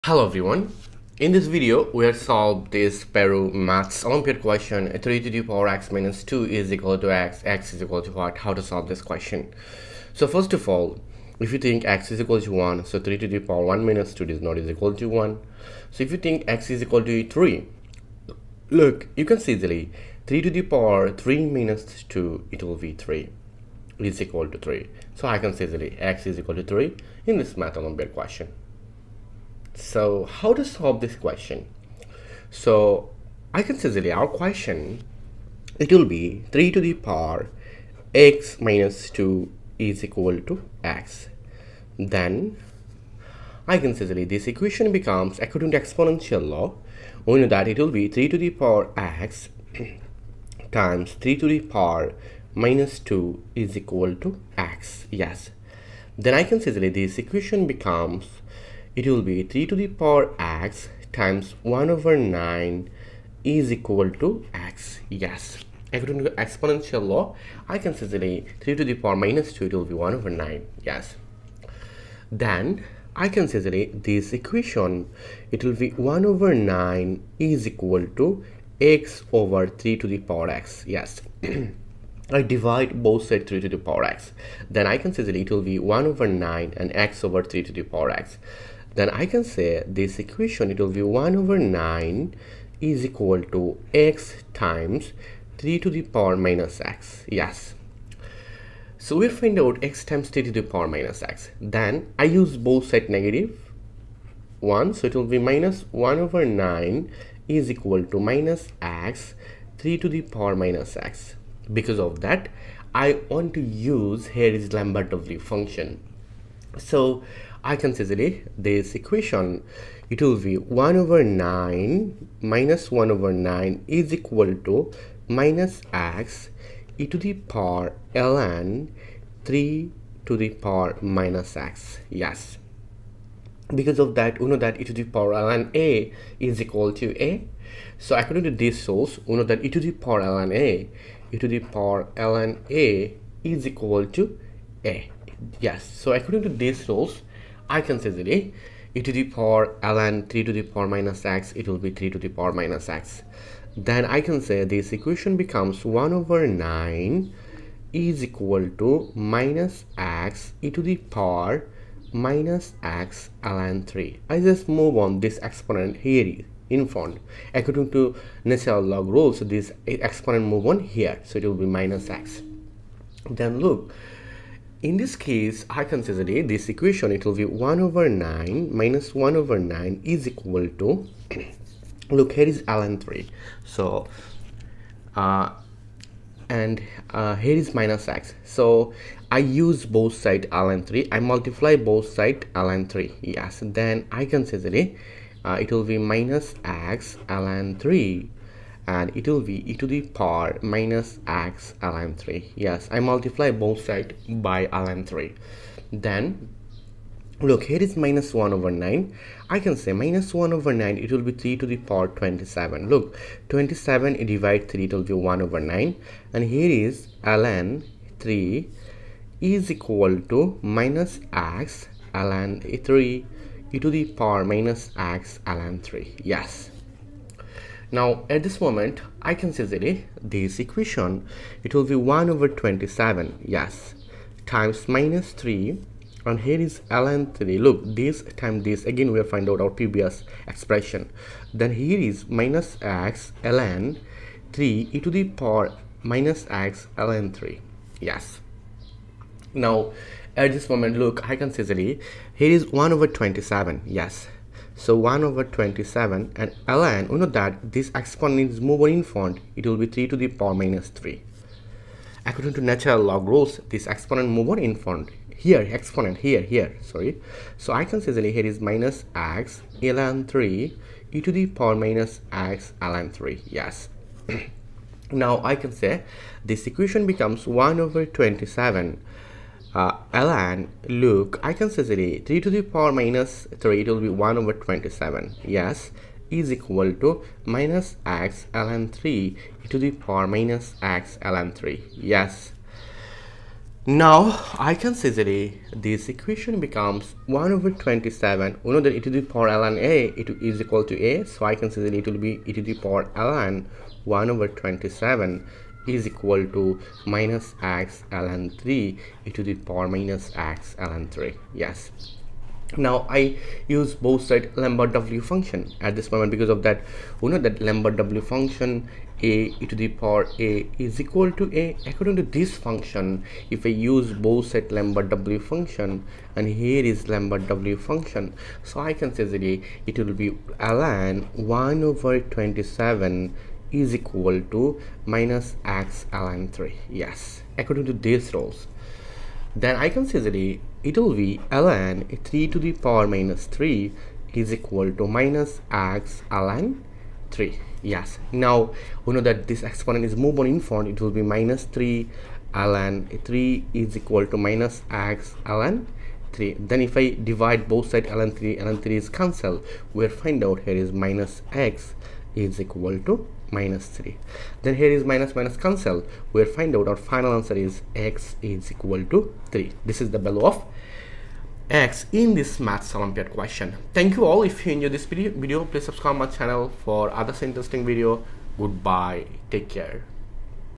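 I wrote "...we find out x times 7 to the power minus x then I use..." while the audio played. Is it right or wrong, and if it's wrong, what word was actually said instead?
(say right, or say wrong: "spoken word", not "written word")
wrong: "3", not "7".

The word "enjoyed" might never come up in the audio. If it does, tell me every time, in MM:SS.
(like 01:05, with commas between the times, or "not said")
06:14.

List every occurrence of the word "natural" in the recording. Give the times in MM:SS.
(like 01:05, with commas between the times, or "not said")
02:48, 04:22.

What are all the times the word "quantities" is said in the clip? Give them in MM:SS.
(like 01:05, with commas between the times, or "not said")
not said.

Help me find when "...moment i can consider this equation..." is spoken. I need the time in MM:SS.
03:48.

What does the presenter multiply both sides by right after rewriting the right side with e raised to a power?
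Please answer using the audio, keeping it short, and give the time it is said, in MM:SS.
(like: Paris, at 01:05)
ln 3, at 03:11.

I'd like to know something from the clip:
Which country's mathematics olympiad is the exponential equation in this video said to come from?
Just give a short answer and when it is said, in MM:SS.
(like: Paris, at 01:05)
Peru, at 00:03.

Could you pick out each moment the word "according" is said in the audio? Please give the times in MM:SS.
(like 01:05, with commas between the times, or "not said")
00:45, 01:05, 02:18, 02:26, 02:47, 04:22, 05:21, 05:37.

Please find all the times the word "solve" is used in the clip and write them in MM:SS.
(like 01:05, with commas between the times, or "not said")
00:02, 00:08, 00:30.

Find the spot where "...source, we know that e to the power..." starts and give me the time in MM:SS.
02:18.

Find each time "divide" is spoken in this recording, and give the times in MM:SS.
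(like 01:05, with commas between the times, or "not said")
01:22, 03:34, 05:57.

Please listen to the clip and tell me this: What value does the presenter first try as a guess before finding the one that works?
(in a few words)
1.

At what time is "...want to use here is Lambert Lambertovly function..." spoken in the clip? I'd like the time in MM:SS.
01:53.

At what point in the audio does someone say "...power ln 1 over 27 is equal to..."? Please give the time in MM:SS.
05:02.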